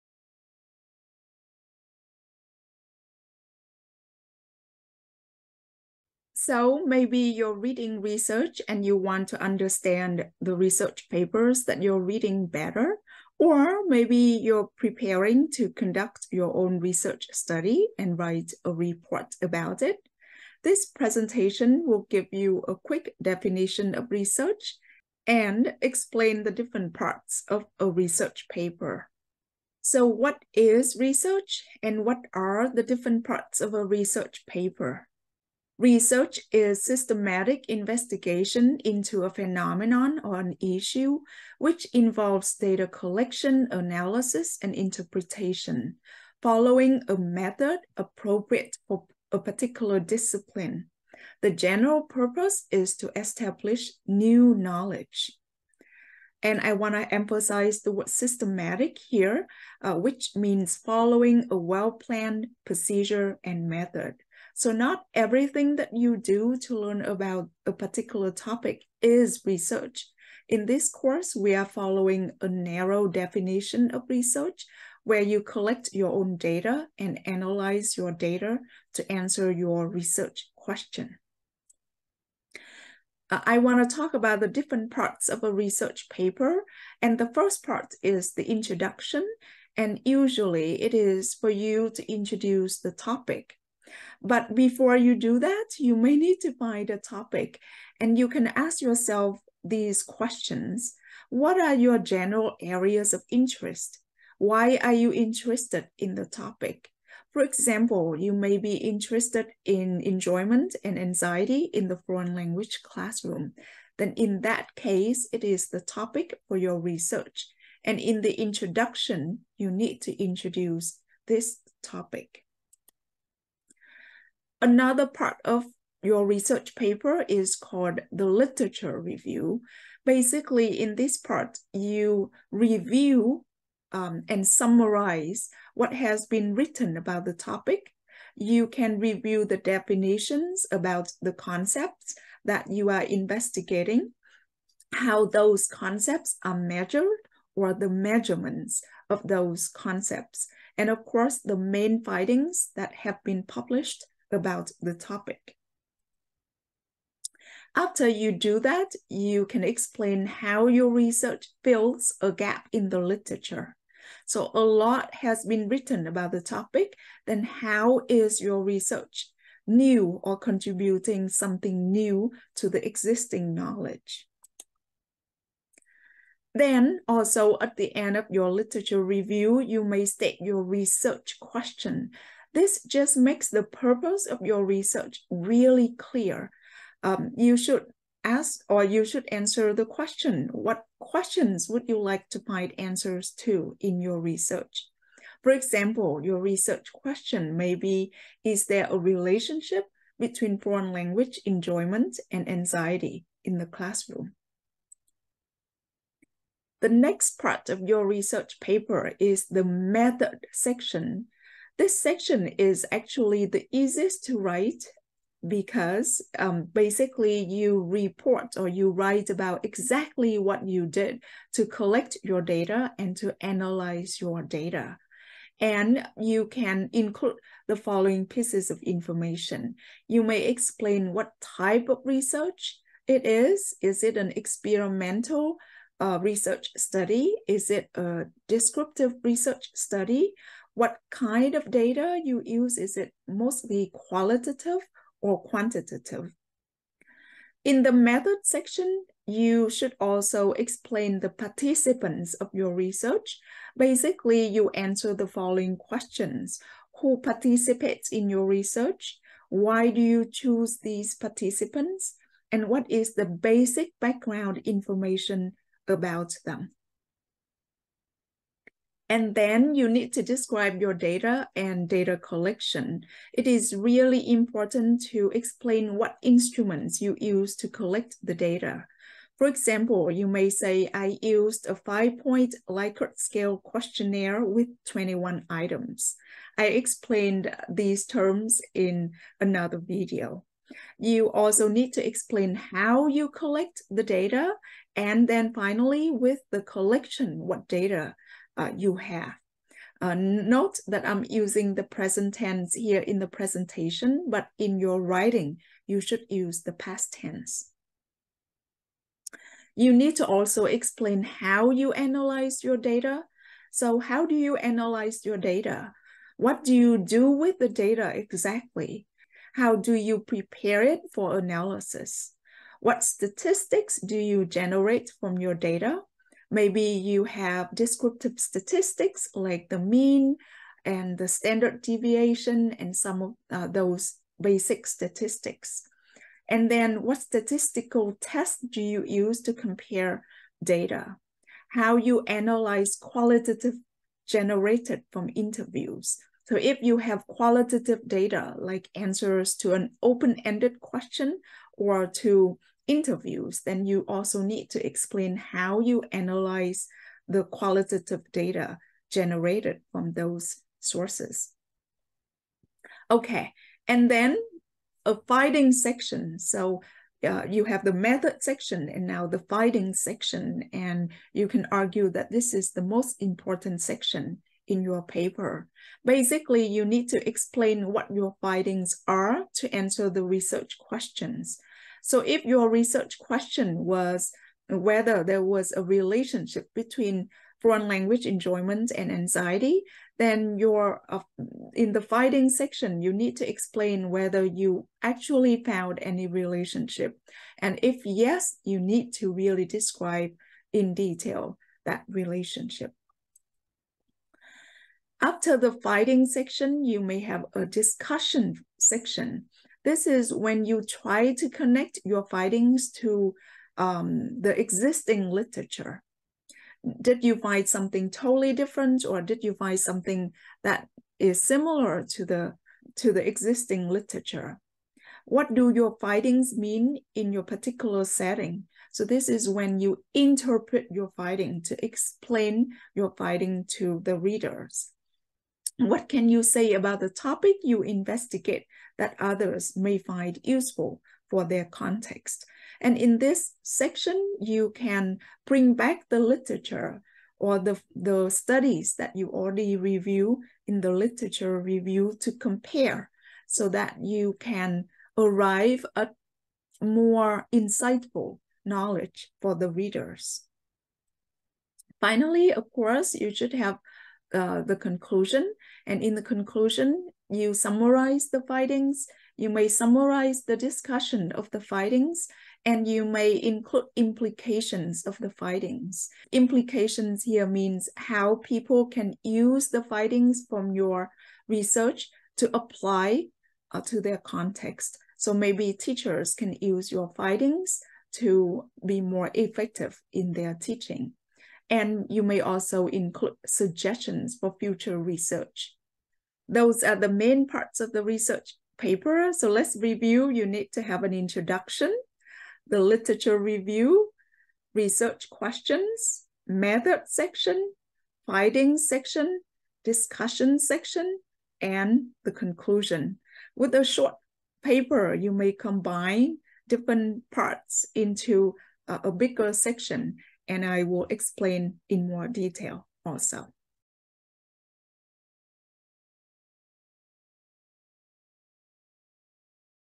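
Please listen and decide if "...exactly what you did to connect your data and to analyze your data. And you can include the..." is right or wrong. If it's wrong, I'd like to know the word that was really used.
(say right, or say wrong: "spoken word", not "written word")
wrong: "collect", not "connect".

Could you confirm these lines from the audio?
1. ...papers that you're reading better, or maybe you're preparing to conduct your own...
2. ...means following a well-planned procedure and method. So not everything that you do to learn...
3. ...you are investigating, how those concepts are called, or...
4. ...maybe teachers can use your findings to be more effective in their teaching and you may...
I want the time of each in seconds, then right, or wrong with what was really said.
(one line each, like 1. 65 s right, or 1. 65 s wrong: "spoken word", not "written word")
1. 11 s right
2. 60 s right
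3. 142 s wrong: "measured", not "called"
4. 485 s right.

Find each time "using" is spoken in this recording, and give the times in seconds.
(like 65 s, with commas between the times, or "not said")
301 s.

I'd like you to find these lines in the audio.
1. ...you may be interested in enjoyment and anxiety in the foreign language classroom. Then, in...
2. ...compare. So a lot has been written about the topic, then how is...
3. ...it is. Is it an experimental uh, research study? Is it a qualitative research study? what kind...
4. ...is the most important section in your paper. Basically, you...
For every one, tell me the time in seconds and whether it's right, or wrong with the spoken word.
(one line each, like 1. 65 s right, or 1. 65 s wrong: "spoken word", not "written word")
1. 108 s right
2. 162 s wrong: "literature", not "compare"
3. 233 s wrong: "descriptive", not "qualitative"
4. 372 s right.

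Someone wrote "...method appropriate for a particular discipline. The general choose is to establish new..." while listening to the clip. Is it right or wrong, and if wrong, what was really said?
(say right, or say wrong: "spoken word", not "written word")
wrong: "purpose", not "choose".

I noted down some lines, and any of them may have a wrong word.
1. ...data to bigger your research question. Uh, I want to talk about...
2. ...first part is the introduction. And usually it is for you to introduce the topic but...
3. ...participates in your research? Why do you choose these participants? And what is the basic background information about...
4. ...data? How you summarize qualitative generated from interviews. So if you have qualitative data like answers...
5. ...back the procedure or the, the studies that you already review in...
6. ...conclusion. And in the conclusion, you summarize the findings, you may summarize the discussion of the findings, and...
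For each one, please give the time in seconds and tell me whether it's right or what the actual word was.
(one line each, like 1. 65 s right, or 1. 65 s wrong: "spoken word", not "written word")
1. 78 s wrong: "answer", not "bigger"
2. 87 s right
3. 257 s right
4. 340 s wrong: "analyze", not "summarize"
5. 445 s wrong: "literature", not "procedure"
6. 464 s right.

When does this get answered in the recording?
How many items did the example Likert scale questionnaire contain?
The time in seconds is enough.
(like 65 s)
284 s.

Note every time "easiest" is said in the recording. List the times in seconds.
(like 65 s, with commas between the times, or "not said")
213 s.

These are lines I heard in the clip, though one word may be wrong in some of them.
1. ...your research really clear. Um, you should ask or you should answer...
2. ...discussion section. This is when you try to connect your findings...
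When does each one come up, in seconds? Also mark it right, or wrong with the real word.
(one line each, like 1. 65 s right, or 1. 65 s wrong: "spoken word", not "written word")
1. 184 s right
2. 407 s right.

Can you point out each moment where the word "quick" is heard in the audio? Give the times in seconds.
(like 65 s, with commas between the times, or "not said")
22 s.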